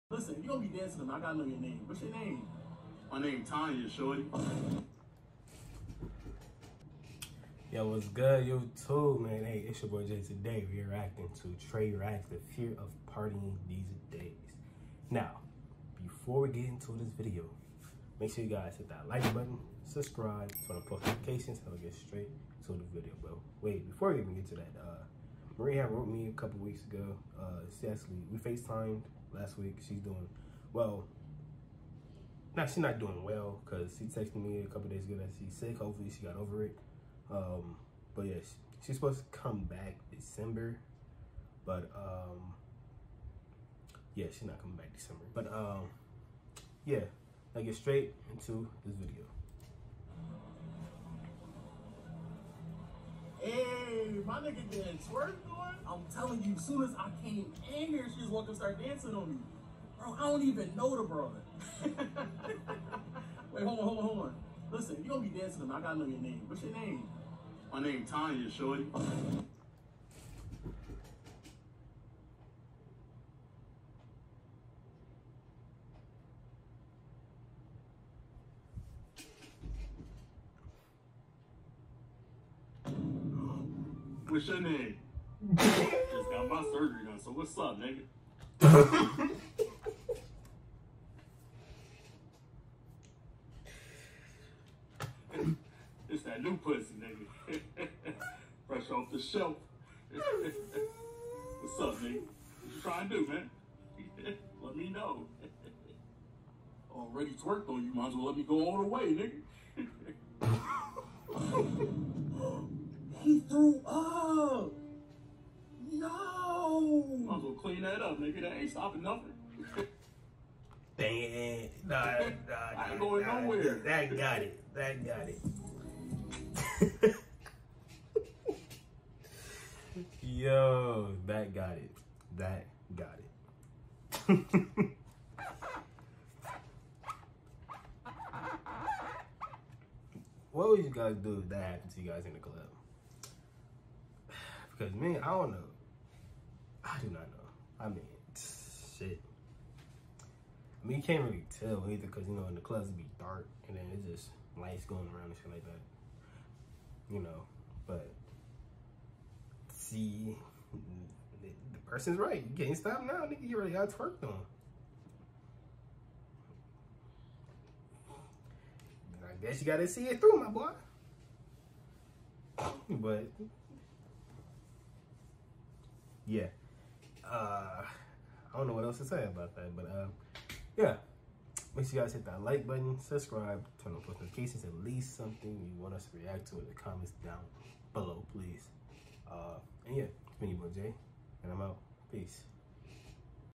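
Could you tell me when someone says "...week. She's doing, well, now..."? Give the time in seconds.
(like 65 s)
29 s.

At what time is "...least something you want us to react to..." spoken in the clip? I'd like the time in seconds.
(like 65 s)
184 s.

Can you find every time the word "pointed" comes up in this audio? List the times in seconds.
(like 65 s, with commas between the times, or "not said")
not said.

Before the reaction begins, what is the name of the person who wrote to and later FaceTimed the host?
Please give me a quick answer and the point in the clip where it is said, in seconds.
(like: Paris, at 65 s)
Maria, at 25 s.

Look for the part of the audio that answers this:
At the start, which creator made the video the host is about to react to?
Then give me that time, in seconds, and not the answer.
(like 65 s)
11 s.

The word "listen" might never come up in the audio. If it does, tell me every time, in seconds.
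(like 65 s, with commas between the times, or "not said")
0 s, 64 s.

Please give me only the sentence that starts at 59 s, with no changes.
Bro, I don't even know the brother.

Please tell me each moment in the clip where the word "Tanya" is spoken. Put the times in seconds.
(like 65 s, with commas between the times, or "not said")
3 s, 68 s.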